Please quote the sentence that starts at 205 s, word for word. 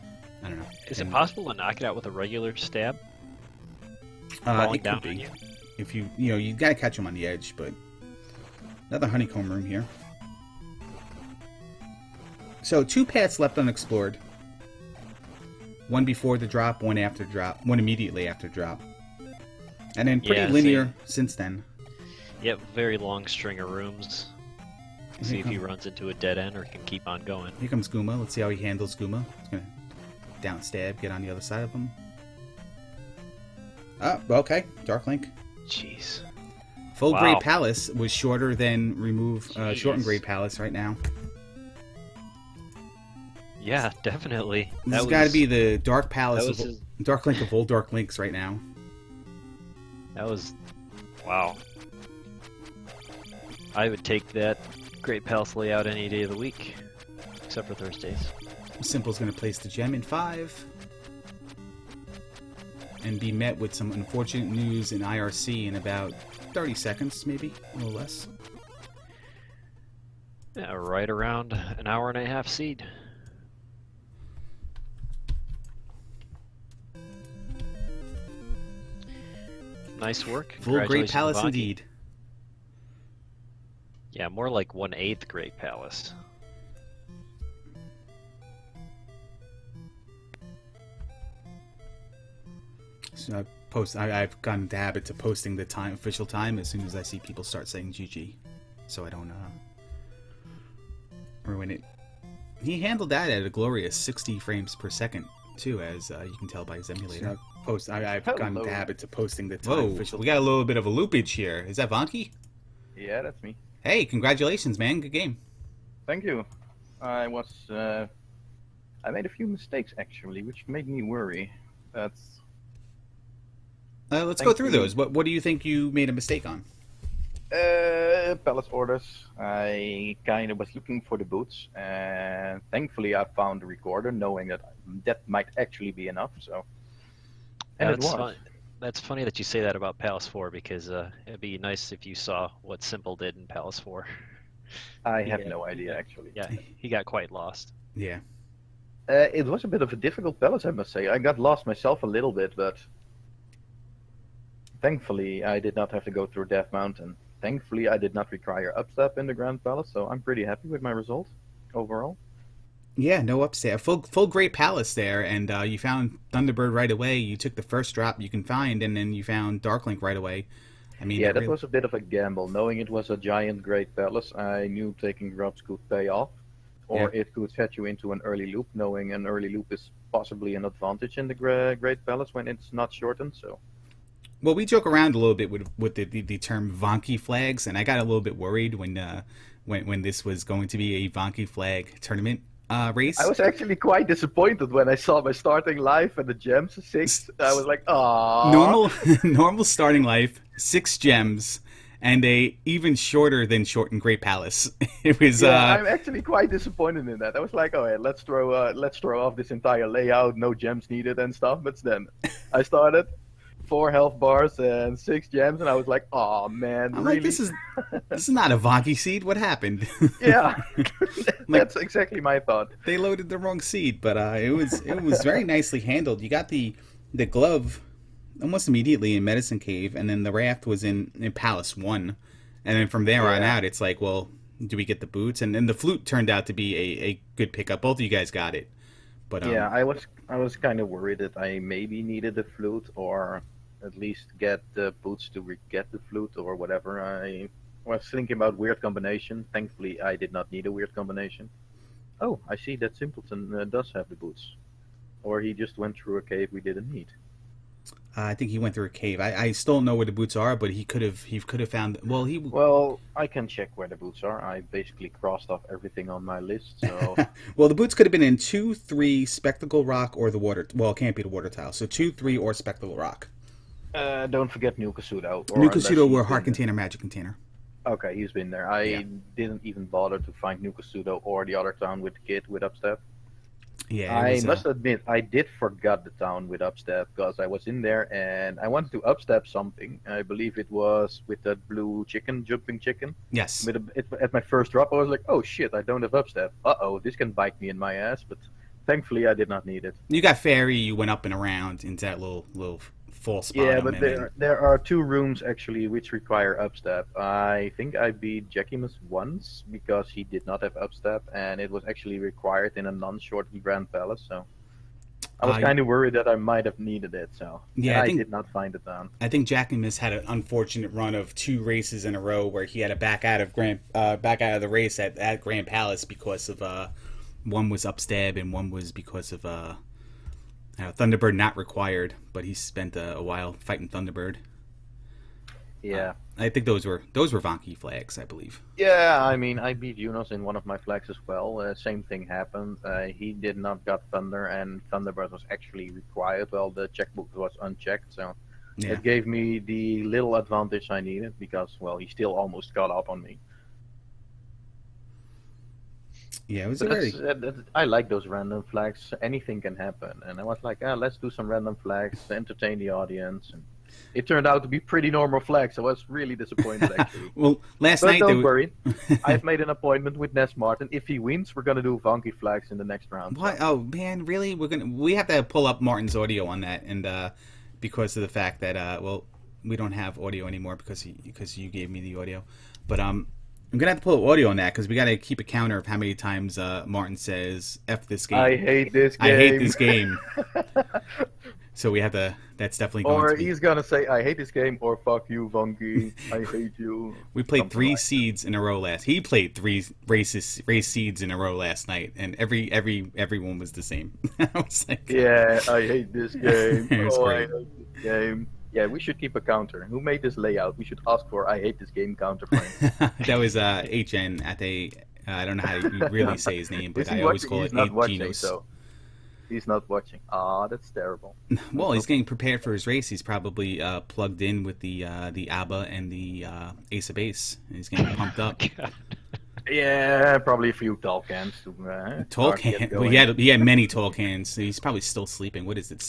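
Yeah, uh, I'm actually quite disappointed in that.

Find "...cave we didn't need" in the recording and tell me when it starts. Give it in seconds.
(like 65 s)
256 s.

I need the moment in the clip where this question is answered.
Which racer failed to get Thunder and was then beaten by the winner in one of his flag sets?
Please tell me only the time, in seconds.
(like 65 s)
339 s.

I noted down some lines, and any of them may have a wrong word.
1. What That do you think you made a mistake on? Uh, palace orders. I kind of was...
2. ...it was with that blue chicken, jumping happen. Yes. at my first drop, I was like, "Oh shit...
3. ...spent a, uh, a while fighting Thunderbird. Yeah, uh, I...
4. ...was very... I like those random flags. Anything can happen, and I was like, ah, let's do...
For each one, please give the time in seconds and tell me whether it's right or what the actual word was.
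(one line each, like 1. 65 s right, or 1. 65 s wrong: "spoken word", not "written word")
1. 124 s wrong: "What", not "That"
2. 290 s wrong: "chicken", not "happen"
3. 332 s right
4. 356 s right.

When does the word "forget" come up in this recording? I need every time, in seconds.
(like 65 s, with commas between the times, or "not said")
274 s, 285 s.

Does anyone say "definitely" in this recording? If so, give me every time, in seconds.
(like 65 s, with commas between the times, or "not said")
44 s, 392 s.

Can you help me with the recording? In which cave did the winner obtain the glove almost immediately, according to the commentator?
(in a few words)
Medicine Cave.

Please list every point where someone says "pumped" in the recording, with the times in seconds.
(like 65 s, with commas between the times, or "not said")
428 s.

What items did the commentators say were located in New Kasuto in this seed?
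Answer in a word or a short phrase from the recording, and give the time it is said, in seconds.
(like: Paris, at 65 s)
Heart container, magic container, at 276 s.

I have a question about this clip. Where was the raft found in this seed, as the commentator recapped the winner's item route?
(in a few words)
Palace One.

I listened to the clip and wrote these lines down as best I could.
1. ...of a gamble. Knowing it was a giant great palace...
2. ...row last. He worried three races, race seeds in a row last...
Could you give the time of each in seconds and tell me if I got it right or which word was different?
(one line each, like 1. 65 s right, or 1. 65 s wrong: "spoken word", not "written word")
1. 171 s right
2. 398 s wrong: "played", not "worried".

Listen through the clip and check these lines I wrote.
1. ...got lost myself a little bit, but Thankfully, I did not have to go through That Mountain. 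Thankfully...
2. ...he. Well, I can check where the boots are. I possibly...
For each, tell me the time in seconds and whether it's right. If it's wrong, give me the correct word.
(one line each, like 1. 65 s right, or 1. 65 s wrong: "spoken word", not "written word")
1. 151 s wrong: "Death", not "That"
2. 262 s wrong: "basically", not "possibly".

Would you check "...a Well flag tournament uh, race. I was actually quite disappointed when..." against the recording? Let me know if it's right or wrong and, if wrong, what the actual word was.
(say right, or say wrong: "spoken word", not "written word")
wrong: "Vonkie", not "Well".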